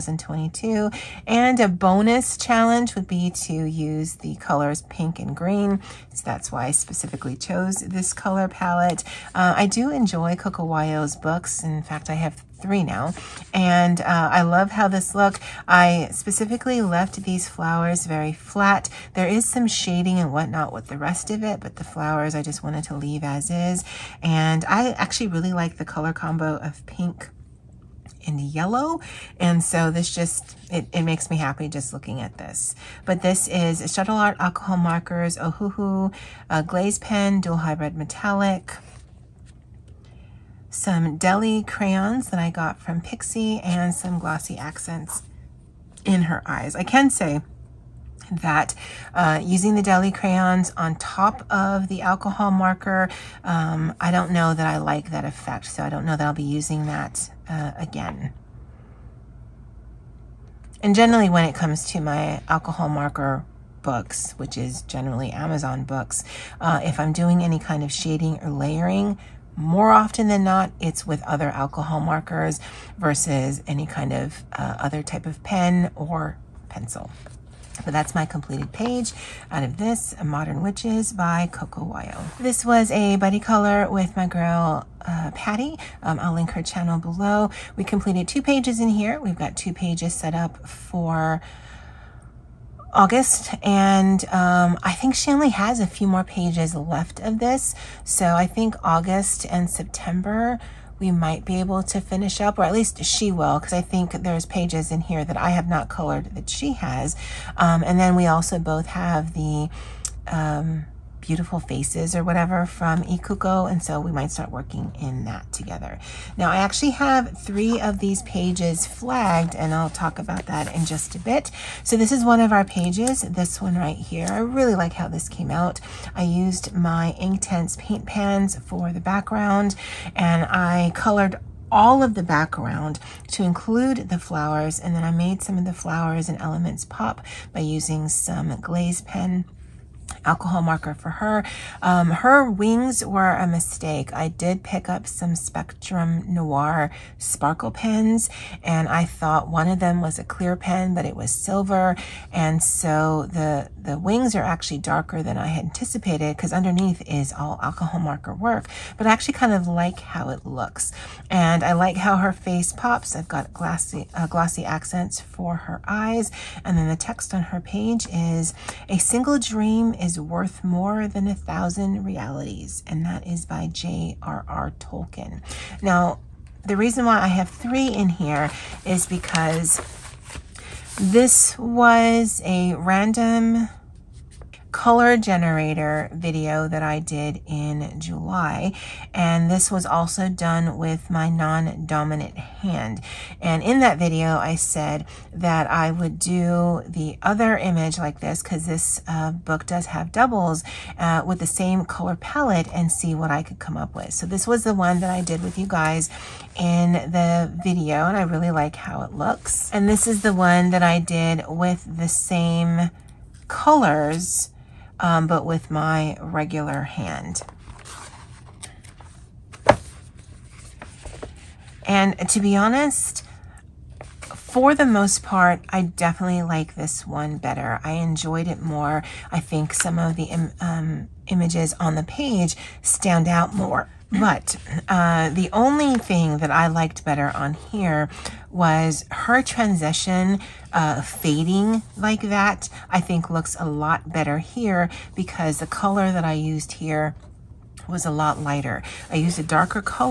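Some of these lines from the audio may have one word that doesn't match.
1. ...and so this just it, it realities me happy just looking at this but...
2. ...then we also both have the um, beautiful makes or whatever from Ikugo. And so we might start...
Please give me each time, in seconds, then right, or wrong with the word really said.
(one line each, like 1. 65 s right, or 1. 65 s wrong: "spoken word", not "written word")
1. 29 s wrong: "makes", not "realities"
2. 107 s wrong: "faces", not "makes".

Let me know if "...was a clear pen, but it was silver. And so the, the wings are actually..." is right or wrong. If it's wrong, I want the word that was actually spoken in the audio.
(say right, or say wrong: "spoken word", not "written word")
right.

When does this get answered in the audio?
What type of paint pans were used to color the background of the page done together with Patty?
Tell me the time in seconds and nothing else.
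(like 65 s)
127 s.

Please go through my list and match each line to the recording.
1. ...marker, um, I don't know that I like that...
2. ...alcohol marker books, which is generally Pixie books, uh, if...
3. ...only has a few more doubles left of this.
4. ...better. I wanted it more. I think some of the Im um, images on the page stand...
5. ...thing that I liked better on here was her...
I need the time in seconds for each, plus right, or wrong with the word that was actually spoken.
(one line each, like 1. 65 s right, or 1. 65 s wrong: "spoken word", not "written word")
1. 52 s right
2. 62 s wrong: "Amazon", not "Pixie"
3. 95 s wrong: "pages", not "doubles"
4. 227 s wrong: "enjoyed", not "wanted"
5. 235 s right.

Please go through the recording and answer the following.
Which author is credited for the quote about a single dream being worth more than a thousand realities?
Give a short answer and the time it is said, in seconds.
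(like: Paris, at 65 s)
J.R.R. Tolkien, at 173 s.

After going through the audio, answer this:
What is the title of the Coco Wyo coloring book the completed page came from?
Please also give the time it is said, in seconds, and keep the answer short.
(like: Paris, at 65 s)
Modern Witches, at 80 s.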